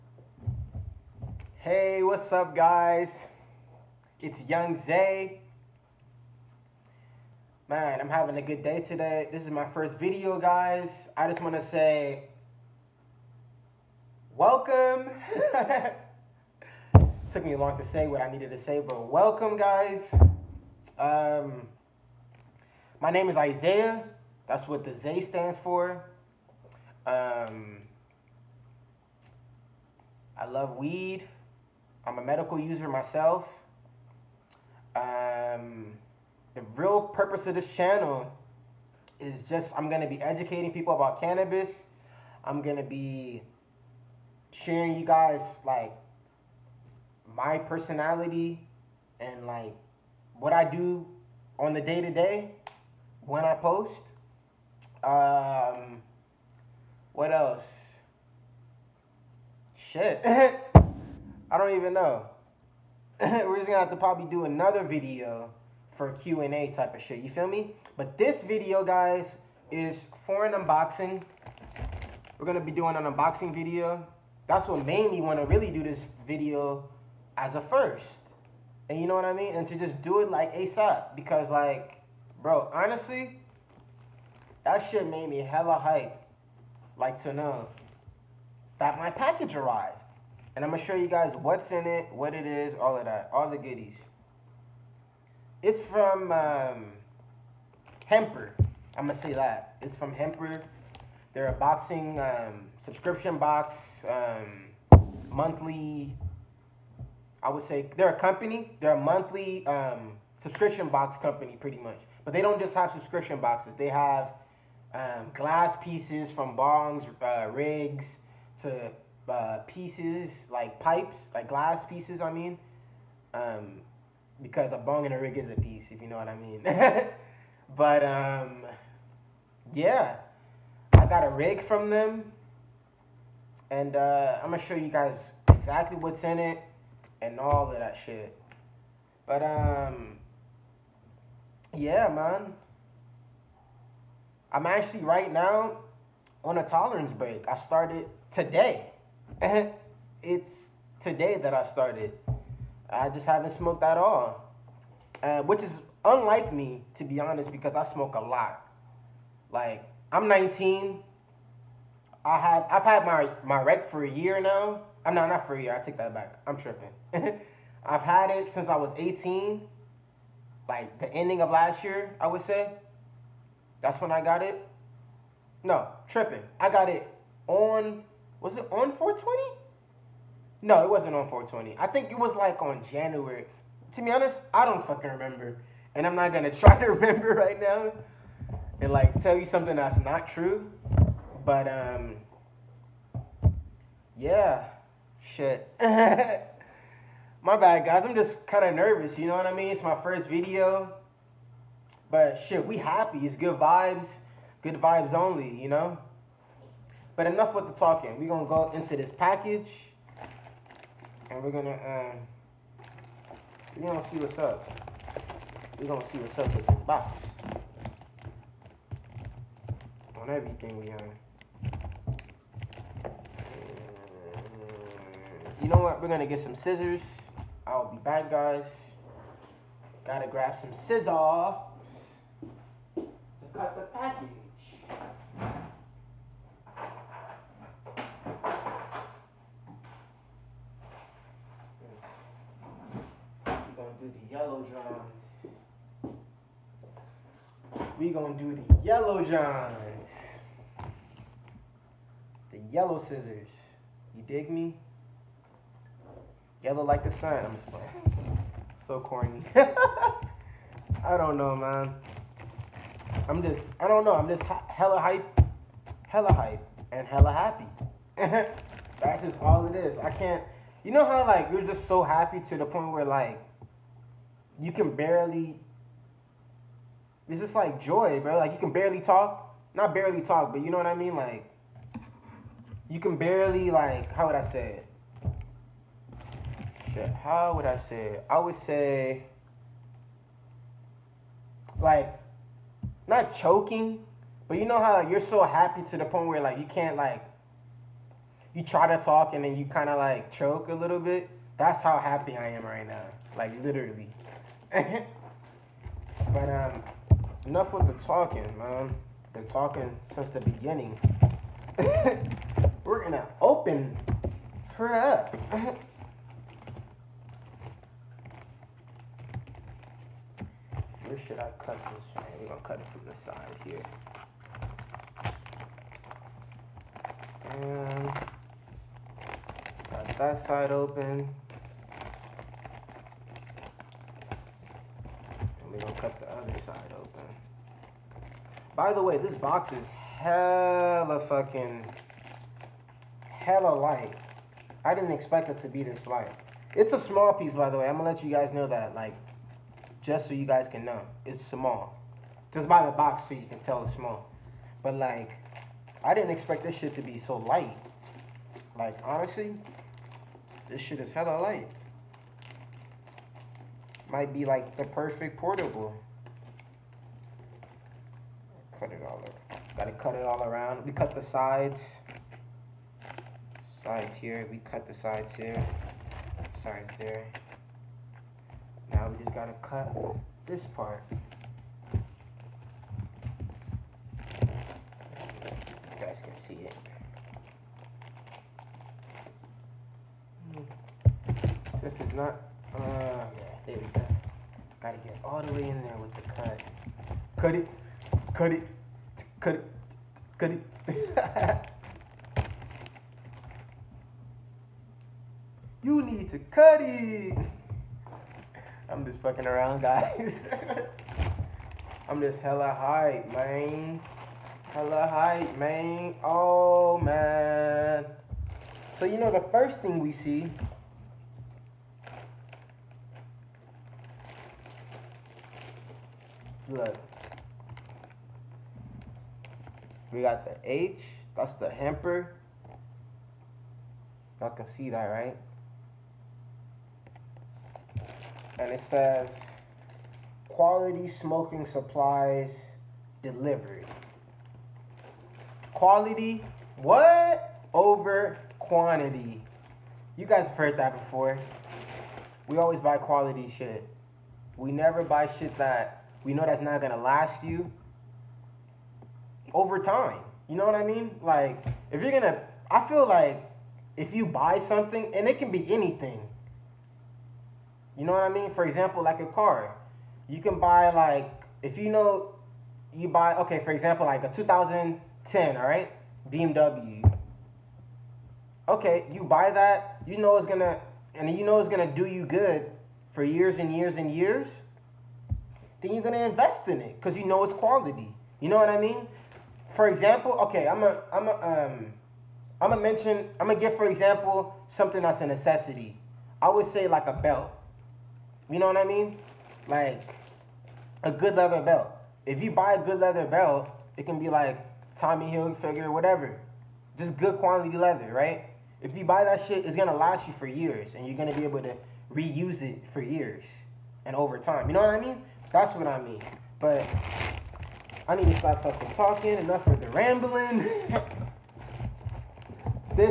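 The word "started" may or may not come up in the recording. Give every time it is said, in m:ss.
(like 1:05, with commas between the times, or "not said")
2:27, 2:31.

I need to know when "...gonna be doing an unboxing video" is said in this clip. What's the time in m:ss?
1:12.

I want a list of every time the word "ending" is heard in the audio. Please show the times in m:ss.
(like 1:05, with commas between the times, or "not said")
2:51.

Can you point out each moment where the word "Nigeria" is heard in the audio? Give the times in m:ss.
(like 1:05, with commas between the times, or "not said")
not said.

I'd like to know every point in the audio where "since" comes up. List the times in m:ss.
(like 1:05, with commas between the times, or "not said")
2:48, 5:10.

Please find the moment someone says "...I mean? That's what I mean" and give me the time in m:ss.
8:34.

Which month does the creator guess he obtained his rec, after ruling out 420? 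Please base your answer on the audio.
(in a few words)
January.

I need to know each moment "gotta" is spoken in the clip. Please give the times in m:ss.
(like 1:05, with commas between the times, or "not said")
3:50, 6:09, 6:19, 6:34.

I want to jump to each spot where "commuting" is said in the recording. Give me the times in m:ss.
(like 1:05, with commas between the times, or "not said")
not said.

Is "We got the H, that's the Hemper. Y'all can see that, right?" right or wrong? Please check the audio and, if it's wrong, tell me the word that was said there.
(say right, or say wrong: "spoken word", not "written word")
right.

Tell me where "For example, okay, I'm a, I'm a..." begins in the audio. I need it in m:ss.
8:09.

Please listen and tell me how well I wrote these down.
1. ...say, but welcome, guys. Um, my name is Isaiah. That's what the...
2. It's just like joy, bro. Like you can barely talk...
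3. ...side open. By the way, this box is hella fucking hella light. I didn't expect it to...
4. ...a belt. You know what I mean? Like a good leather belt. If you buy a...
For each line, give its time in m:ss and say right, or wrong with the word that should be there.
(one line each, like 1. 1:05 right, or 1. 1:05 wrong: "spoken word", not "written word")
1. 0:18 right
2. 4:37 right
3. 5:36 right
4. 8:17 right.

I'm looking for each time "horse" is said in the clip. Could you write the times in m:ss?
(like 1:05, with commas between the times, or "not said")
not said.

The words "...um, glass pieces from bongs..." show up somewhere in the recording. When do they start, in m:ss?
1:54.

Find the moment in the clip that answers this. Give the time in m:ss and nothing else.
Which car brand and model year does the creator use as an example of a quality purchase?
7:54.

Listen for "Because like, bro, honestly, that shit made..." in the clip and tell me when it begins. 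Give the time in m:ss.
1:21.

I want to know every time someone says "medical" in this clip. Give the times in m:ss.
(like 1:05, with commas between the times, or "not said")
0:32.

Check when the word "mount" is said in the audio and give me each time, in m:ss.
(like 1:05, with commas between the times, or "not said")
not said.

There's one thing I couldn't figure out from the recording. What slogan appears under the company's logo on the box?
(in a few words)
Quality smoking supplies delivered.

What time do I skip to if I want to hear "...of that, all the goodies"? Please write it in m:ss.
1:32.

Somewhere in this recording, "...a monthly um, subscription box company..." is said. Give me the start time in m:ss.
1:48.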